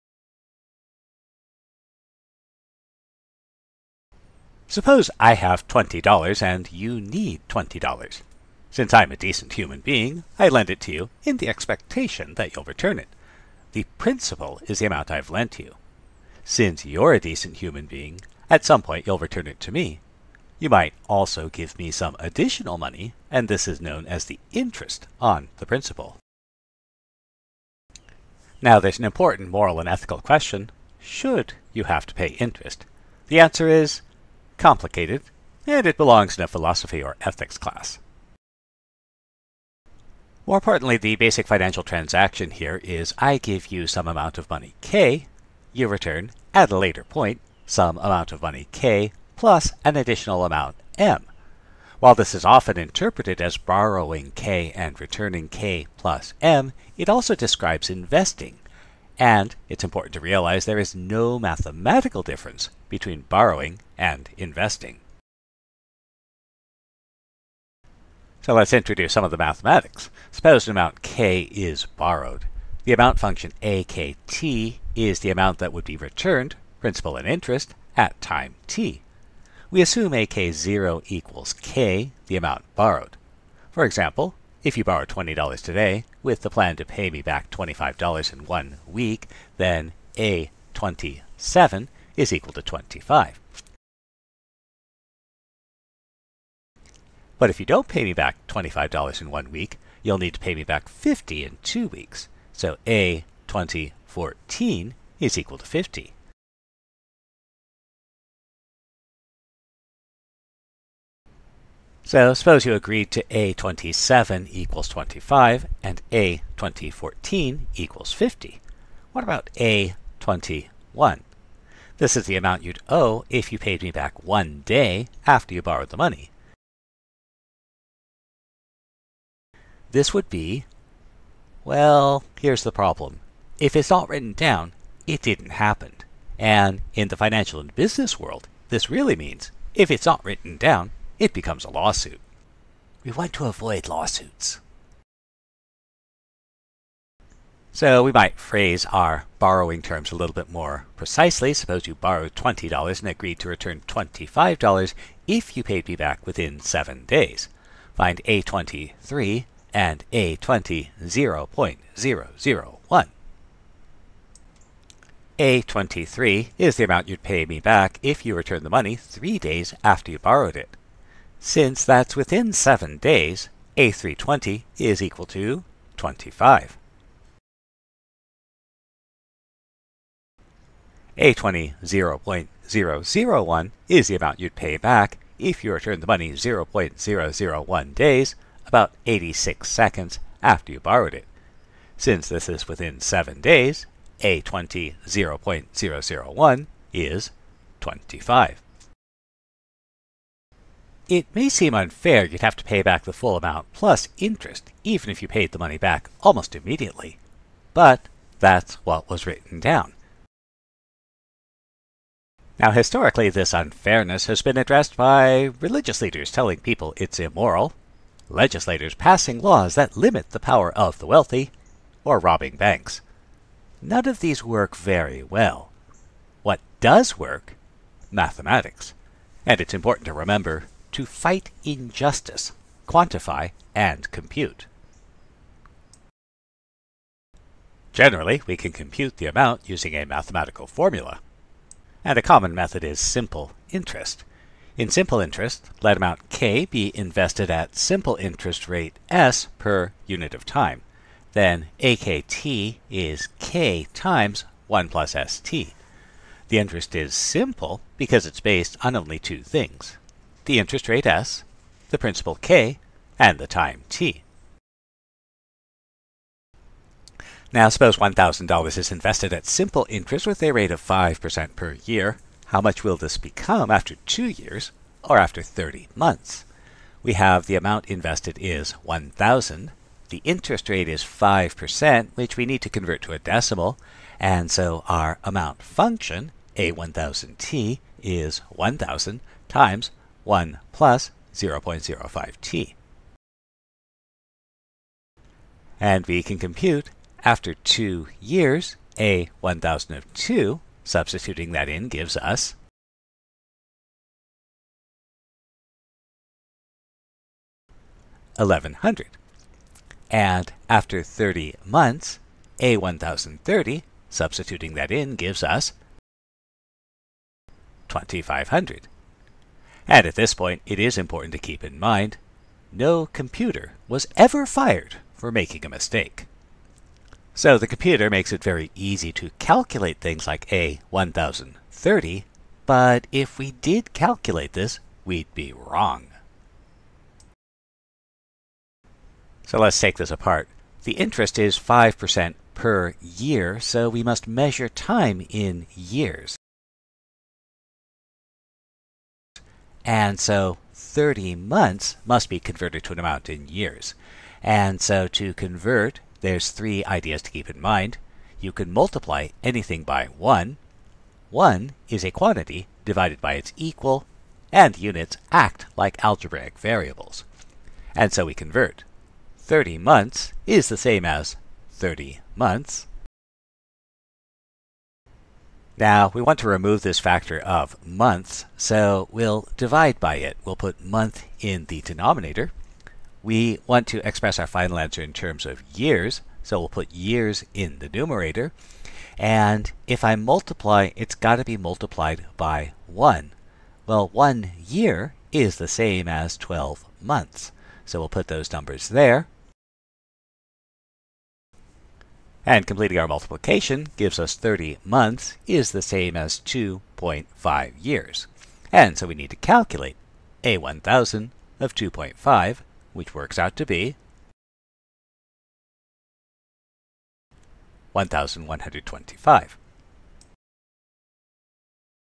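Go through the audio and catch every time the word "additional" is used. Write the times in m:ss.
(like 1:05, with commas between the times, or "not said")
0:22, 0:49.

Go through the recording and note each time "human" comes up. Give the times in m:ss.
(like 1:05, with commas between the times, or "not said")
0:09, 0:17.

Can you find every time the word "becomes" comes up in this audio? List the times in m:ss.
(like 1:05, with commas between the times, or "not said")
2:21, 4:33.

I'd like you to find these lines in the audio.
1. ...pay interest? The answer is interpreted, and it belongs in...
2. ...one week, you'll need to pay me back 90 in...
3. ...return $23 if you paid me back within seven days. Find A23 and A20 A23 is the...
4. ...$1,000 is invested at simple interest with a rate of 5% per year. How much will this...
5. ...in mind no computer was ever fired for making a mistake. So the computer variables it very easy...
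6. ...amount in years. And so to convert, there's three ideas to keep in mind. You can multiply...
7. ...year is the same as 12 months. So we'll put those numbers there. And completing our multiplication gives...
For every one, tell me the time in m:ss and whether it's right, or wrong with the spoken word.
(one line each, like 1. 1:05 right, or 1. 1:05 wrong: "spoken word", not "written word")
1. 0:32 wrong: "complicated", not "interpreted"
2. 1:39 wrong: "50", not "90"
3. 2:33 wrong: "25", not "23"
4. 4:27 right
5. 5:21 wrong: "makes", not "variables"
6. 5:52 right
7. 6:34 right.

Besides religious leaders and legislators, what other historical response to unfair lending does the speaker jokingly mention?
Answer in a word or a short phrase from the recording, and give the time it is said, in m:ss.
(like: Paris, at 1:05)
robbing banks, at 3:42.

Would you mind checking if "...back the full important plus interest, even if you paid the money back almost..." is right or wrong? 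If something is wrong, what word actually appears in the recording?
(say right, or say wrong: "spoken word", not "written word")
wrong: "amount", not "important".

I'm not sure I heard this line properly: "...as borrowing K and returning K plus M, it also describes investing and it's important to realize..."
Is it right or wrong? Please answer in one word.
right.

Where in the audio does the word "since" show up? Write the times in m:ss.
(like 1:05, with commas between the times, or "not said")
0:08, 0:16, 2:51, 3:11.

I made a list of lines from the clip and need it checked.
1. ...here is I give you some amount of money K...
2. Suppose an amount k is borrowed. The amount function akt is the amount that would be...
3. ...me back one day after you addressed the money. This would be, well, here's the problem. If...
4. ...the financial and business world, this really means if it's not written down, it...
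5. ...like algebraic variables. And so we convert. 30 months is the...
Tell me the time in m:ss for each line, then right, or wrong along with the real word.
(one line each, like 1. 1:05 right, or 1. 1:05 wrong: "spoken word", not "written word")
1. 0:42 right
2. 1:10 right
3. 2:03 wrong: "borrowed", not "addressed"
4. 2:17 right
5. 6:05 right.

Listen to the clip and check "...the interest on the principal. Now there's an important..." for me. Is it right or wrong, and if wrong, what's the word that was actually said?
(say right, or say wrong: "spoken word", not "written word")
right.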